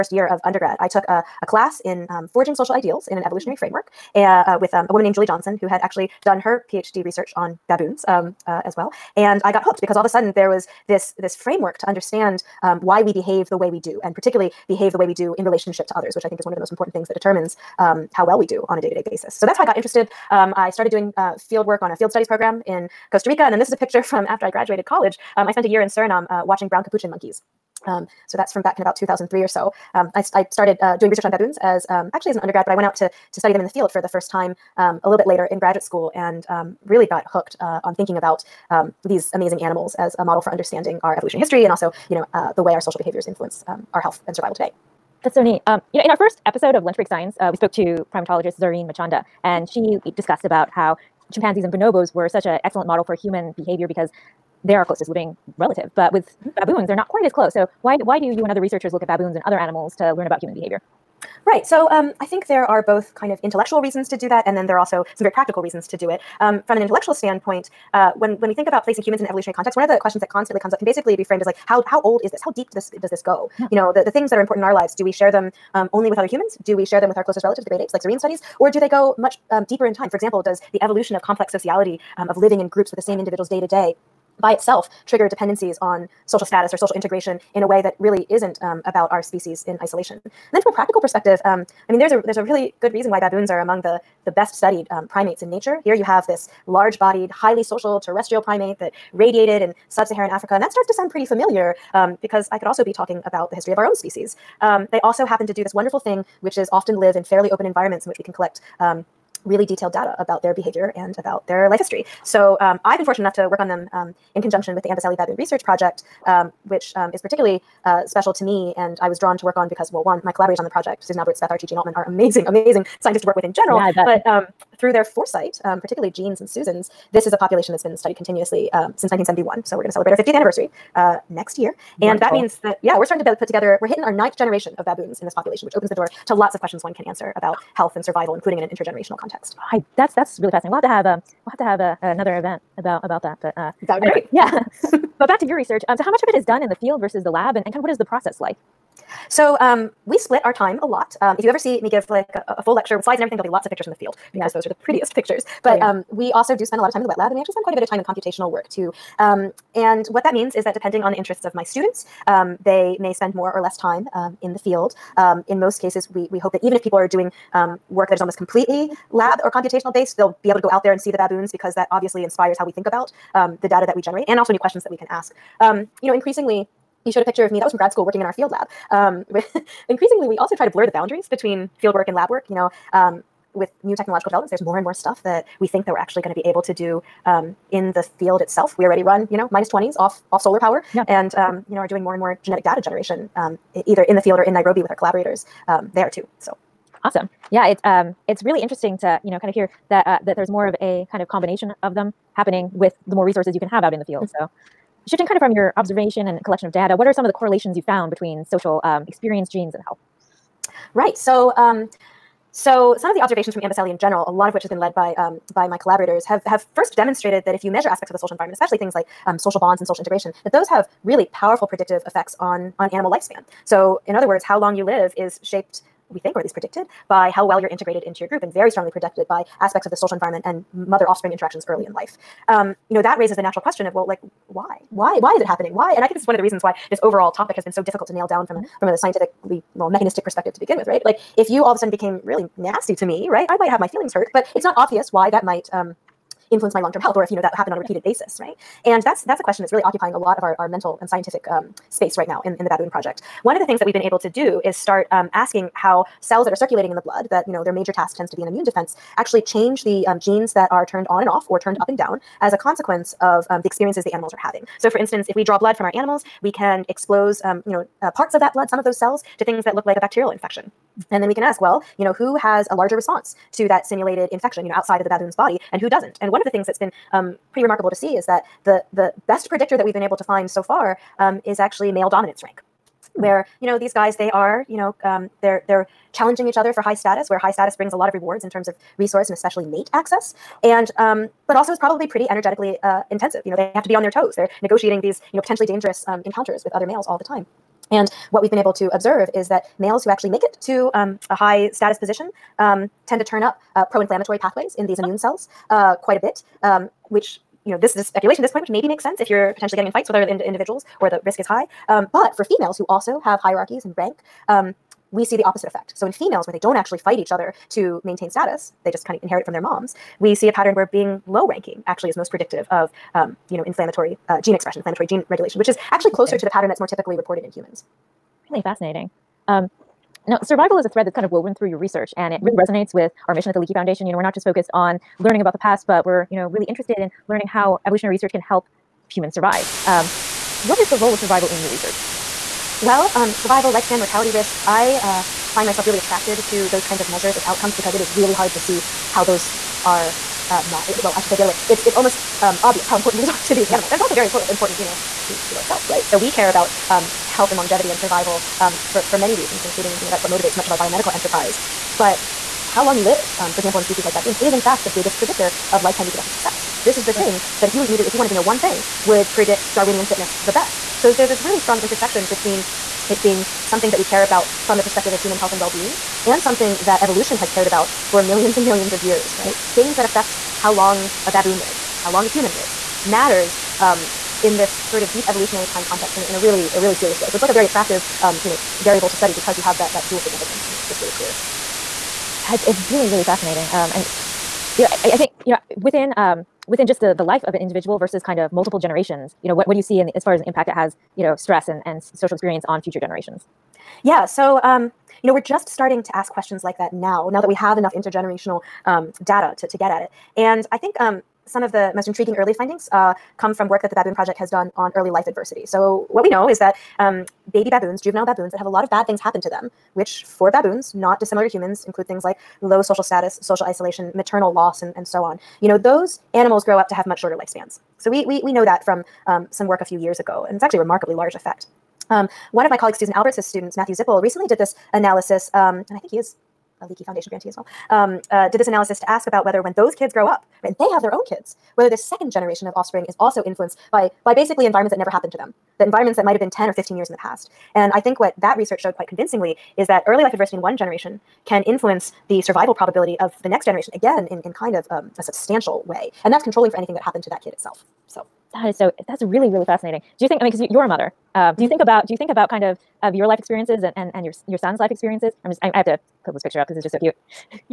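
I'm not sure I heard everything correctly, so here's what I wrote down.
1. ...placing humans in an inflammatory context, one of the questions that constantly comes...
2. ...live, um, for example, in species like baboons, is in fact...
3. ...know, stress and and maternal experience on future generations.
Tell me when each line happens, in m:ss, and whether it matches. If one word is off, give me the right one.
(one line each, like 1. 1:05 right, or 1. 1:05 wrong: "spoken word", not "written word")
1. 1:08 wrong: "evolutionary", not "inflammatory"
2. 6:03 right
3. 6:41 wrong: "social", not "maternal".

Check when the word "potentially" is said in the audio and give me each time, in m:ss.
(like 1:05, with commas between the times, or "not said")
4:55, 5:09.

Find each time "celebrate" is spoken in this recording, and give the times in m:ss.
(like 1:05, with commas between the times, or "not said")
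2:09.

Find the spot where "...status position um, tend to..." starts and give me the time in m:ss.
5:01.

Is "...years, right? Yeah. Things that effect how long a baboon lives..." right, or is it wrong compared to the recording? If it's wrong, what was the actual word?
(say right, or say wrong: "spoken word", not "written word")
wrong: "affect", not "effect".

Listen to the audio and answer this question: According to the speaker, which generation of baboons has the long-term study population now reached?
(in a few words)
ninth.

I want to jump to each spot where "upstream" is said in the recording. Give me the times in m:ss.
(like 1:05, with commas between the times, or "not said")
not said.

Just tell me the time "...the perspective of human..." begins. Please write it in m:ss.
6:14.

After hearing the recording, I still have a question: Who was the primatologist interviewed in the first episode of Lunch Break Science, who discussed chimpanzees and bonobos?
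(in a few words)
Zarin Machanda.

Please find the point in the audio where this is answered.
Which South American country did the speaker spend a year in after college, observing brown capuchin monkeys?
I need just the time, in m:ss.
0:25.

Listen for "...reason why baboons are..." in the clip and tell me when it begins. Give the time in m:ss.
1:32.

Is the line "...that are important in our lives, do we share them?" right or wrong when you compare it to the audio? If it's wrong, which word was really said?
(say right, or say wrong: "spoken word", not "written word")
right.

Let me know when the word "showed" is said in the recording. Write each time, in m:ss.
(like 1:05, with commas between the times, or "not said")
2:57, 7:28.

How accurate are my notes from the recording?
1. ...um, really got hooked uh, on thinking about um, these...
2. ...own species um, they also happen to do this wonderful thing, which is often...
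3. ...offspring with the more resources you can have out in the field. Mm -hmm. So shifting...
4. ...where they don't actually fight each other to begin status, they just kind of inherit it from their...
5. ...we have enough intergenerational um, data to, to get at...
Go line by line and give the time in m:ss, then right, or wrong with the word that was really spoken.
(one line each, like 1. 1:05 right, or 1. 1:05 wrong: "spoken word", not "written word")
1. 0:36 right
2. 1:43 right
3. 3:22 wrong: "happening", not "offspring"
4. 5:16 wrong: "maintain", not "begin"
5. 6:47 right.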